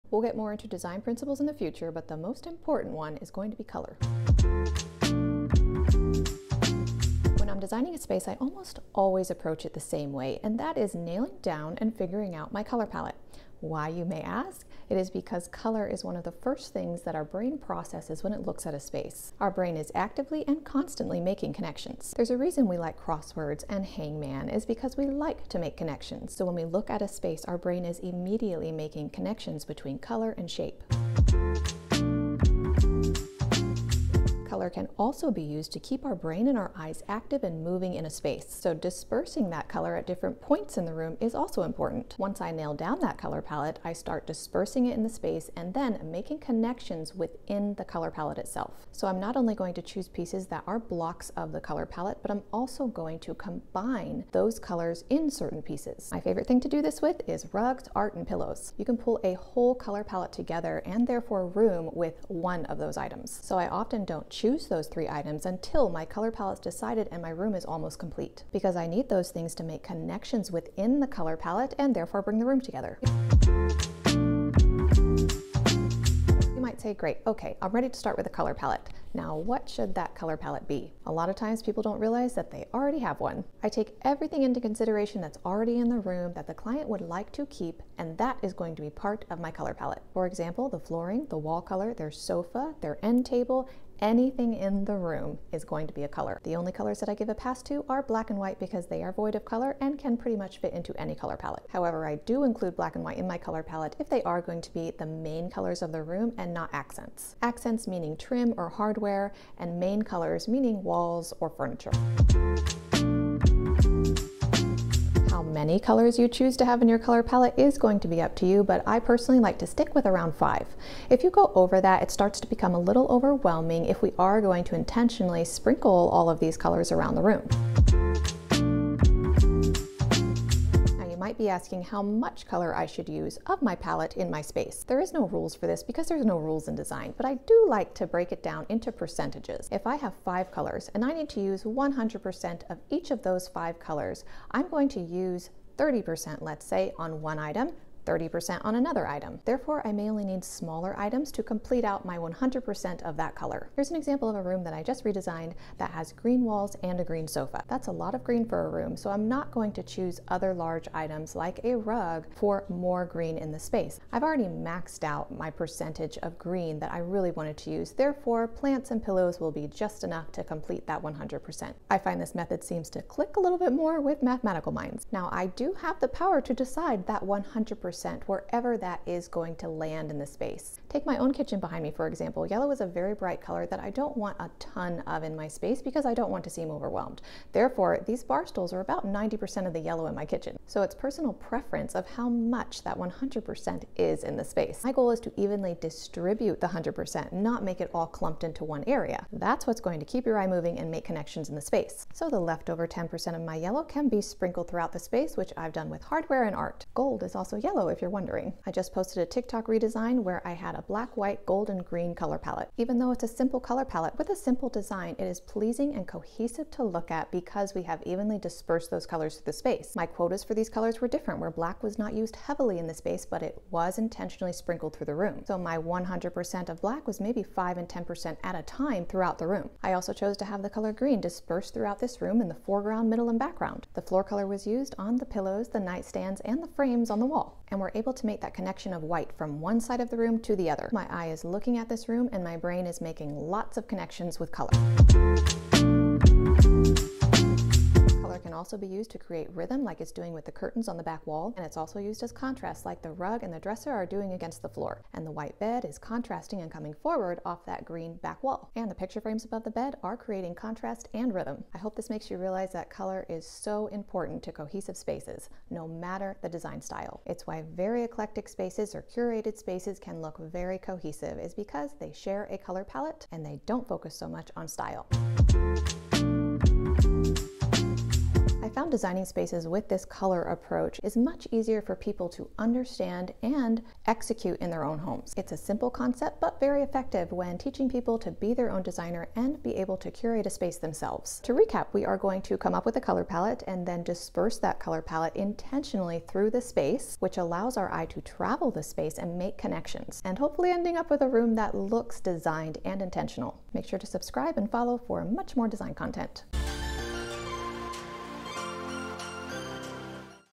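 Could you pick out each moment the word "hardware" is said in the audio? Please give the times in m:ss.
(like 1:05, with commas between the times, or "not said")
1:48, 3:26.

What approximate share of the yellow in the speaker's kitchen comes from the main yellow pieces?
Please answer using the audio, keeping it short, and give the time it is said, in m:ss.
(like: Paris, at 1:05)
90%, at 3:09.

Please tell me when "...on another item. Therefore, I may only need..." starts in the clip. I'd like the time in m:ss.
2:28.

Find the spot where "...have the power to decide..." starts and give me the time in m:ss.
2:55.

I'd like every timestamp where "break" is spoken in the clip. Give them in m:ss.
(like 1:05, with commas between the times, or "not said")
2:18.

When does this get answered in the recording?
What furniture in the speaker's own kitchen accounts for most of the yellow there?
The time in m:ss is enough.
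3:08.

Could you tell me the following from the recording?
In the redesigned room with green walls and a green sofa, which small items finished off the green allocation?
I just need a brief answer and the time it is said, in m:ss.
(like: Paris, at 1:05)
Plants and pillows, at 2:48.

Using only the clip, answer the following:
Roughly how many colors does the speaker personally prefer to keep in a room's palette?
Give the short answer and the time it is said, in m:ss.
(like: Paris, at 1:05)
5, at 2:00.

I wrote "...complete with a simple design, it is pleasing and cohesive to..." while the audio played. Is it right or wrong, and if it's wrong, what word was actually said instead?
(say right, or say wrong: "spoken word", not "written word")
wrong: "palette", not "complete".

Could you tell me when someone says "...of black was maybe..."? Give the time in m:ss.
3:46.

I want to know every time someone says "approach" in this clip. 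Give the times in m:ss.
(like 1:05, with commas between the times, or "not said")
0:09, 4:40.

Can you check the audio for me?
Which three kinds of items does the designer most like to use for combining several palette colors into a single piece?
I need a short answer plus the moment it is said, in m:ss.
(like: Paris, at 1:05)
Rugs, art, and pillows, at 0:57.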